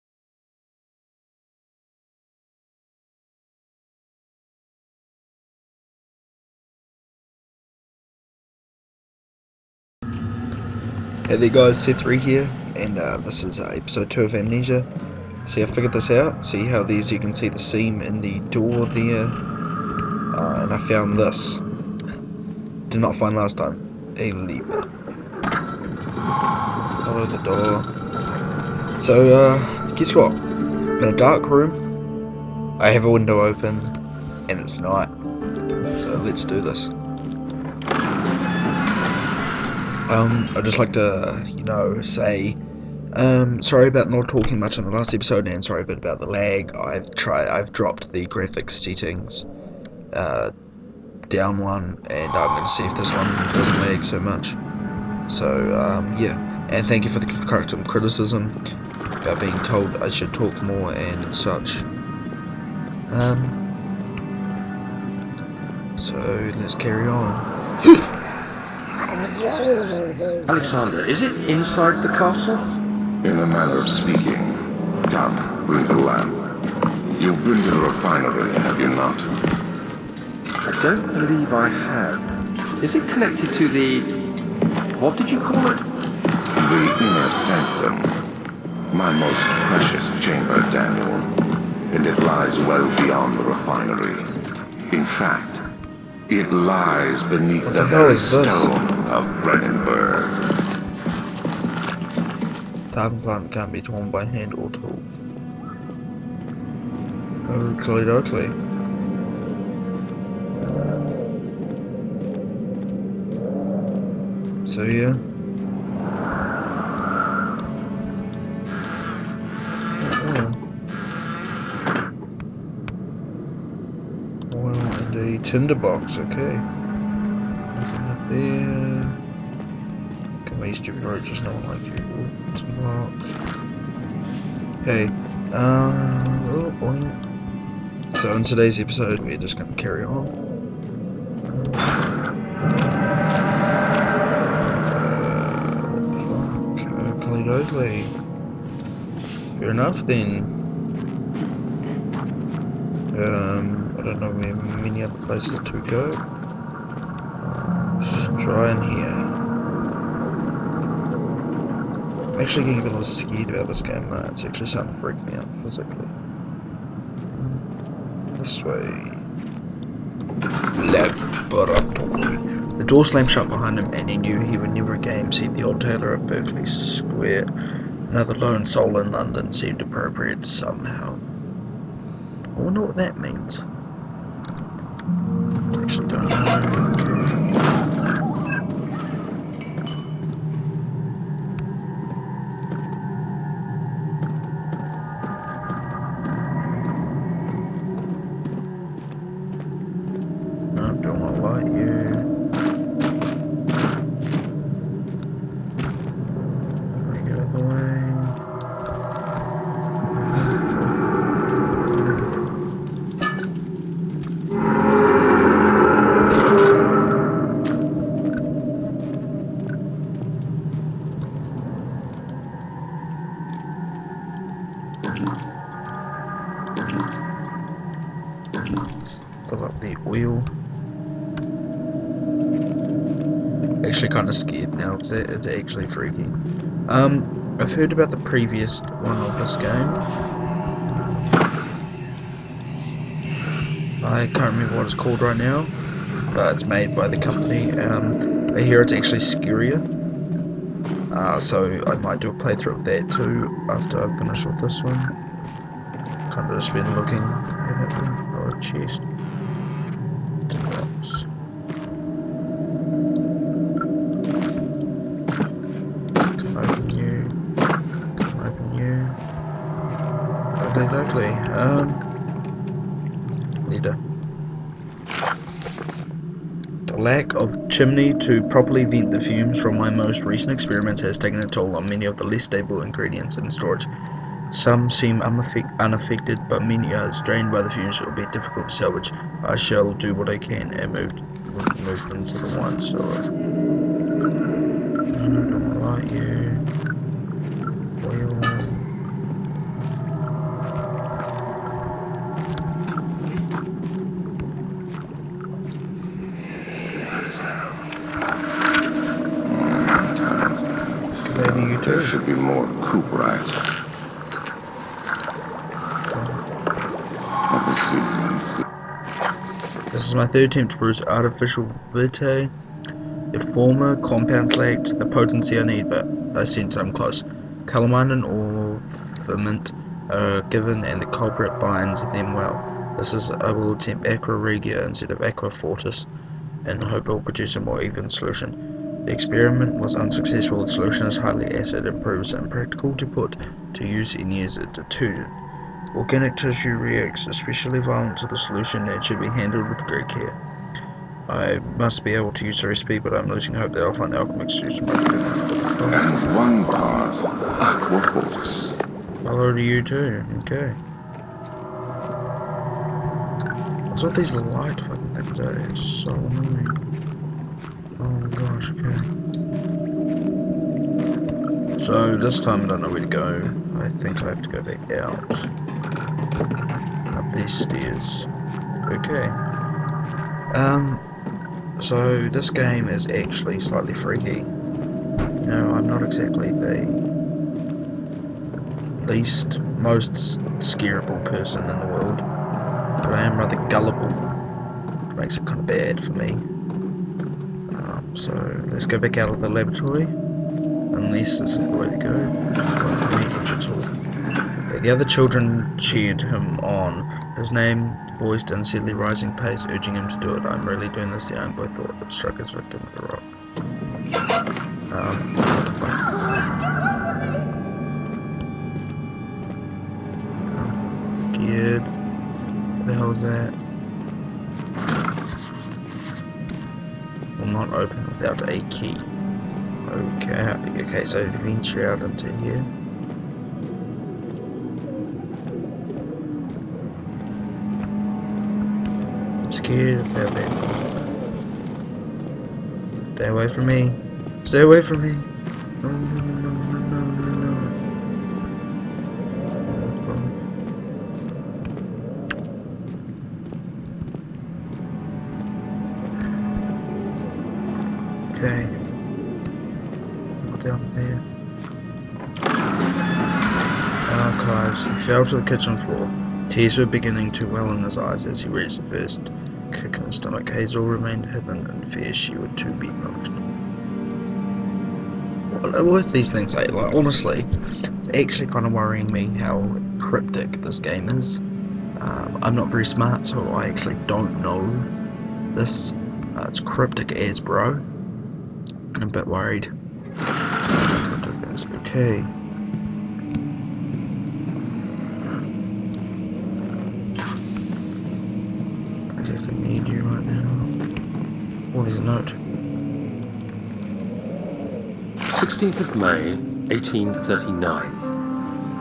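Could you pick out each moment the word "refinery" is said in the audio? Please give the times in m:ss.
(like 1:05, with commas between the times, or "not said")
1:17, 1:33.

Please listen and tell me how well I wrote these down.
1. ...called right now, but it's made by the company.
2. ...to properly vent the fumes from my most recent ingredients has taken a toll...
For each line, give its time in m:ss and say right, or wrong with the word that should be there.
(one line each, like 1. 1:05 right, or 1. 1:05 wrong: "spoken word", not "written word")
1. 4:04 right
2. 4:38 wrong: "experiments", not "ingredients".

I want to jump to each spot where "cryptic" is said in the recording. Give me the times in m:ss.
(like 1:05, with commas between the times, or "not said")
7:59, 8:06.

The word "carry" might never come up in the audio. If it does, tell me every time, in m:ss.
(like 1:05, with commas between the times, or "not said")
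1:06, 2:19.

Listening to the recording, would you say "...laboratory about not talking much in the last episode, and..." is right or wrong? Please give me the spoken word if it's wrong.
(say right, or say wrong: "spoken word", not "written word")
wrong: "sorry", not "laboratory".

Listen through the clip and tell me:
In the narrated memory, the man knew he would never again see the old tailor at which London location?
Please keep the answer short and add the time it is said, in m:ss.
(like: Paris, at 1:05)
Berkeley Square, at 2:56.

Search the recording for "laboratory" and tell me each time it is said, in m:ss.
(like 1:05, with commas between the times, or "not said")
2:50, 6:39.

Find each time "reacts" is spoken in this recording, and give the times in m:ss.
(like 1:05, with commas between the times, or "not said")
5:46.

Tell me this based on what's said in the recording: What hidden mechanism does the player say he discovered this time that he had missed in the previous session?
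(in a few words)
A lever.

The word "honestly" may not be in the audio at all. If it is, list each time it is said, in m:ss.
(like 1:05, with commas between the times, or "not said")
7:56.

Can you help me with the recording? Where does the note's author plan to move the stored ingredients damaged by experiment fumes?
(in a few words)
The wine cellar.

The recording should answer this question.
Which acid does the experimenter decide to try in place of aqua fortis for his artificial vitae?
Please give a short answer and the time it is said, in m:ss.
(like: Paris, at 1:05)
Aqua regia, at 5:34.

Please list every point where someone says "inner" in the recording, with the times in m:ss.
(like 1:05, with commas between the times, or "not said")
1:26.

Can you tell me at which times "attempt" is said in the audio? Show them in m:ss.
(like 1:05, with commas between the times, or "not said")
5:20, 5:33.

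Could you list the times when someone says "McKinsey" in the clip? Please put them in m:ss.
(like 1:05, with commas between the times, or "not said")
not said.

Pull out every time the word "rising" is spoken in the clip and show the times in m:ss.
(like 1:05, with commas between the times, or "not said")
6:48.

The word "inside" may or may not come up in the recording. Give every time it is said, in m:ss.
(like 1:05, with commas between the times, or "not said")
1:11.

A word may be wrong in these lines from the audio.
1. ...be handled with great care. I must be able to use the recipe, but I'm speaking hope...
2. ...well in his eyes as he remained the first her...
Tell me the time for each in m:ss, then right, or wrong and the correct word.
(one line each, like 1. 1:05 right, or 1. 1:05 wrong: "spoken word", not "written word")
1. 5:49 wrong: "losing", not "speaking"
2. 7:47 wrong: "raised", not "remained".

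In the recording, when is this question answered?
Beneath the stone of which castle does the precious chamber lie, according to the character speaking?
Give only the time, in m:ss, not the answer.
1:39.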